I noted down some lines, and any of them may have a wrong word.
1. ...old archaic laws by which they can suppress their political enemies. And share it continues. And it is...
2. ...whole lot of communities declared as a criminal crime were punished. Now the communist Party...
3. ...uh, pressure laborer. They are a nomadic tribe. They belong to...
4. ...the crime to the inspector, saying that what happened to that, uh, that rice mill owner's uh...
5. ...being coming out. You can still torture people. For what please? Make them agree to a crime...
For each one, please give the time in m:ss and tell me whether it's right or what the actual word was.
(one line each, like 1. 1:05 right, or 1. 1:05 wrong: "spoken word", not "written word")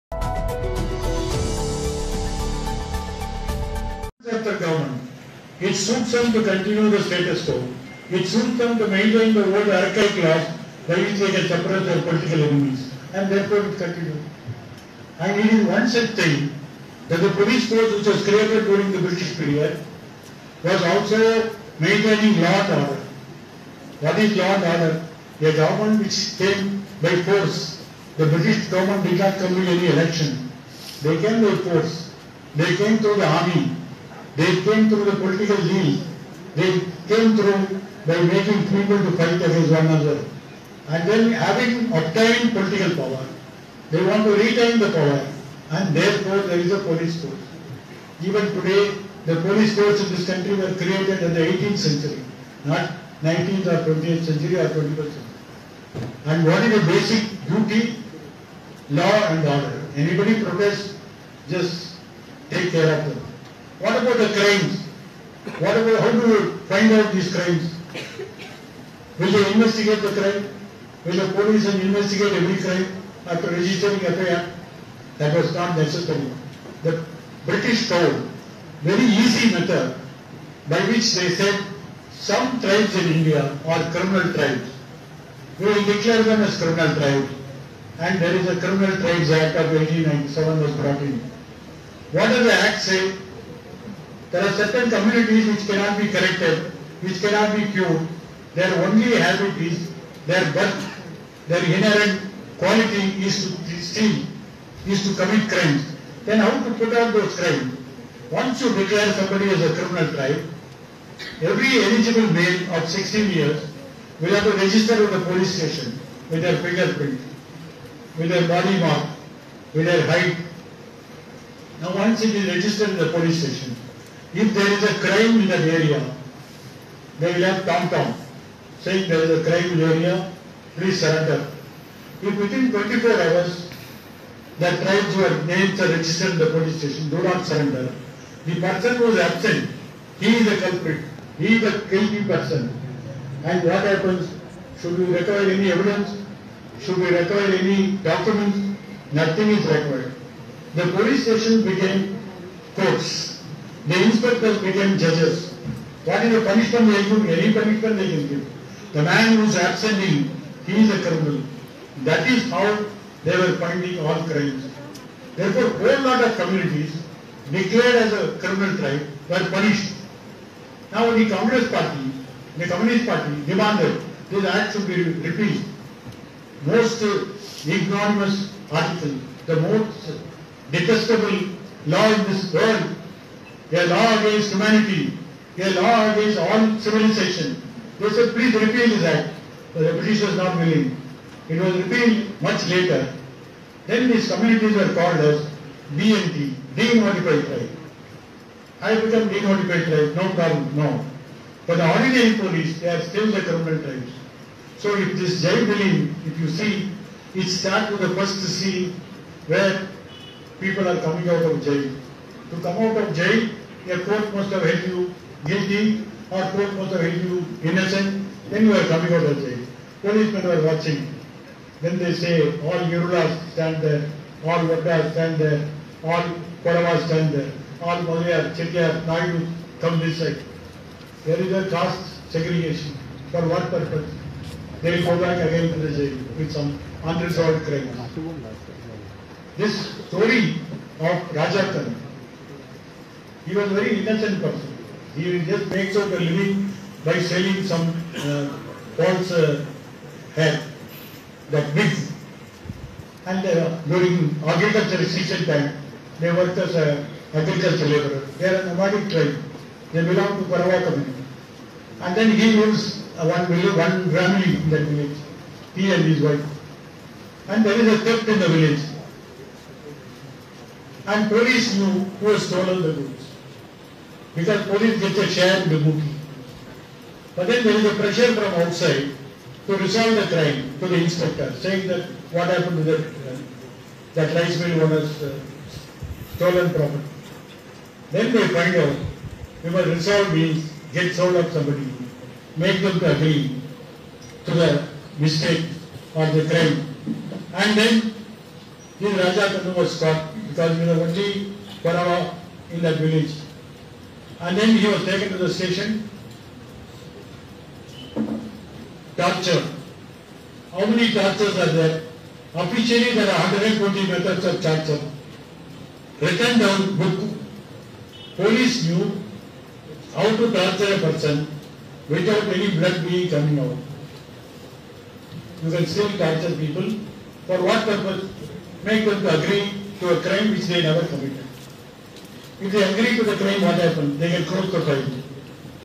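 1. 0:09 wrong: "therefore", not "share"
2. 2:45 right
3. 4:17 wrong: "agriculture", not "pressure"
4. 4:40 right
5. 5:23 wrong: "purpose", not "please".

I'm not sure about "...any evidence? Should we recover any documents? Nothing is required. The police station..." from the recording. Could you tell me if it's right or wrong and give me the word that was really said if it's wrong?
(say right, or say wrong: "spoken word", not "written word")
right.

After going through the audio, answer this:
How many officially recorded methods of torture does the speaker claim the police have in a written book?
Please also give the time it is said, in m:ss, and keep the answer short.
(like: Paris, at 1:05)
120, at 5:13.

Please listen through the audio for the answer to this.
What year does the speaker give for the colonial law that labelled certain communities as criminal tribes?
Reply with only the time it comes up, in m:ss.
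1:29.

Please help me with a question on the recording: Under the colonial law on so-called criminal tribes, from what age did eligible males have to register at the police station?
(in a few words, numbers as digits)
16.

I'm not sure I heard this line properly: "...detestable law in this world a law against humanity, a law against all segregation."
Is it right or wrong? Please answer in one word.
wrong.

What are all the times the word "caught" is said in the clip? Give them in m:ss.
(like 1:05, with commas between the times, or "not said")
4:59.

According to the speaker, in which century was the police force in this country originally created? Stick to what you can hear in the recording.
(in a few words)
18th century.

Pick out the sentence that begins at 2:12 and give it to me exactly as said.
If within 24 hours, the tribes were names are registered in the police station, do not surrender.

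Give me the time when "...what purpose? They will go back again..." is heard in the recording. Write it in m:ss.
3:53.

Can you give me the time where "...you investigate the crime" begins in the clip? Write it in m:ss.
1:09.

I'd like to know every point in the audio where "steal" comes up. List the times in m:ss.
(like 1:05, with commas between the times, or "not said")
1:43.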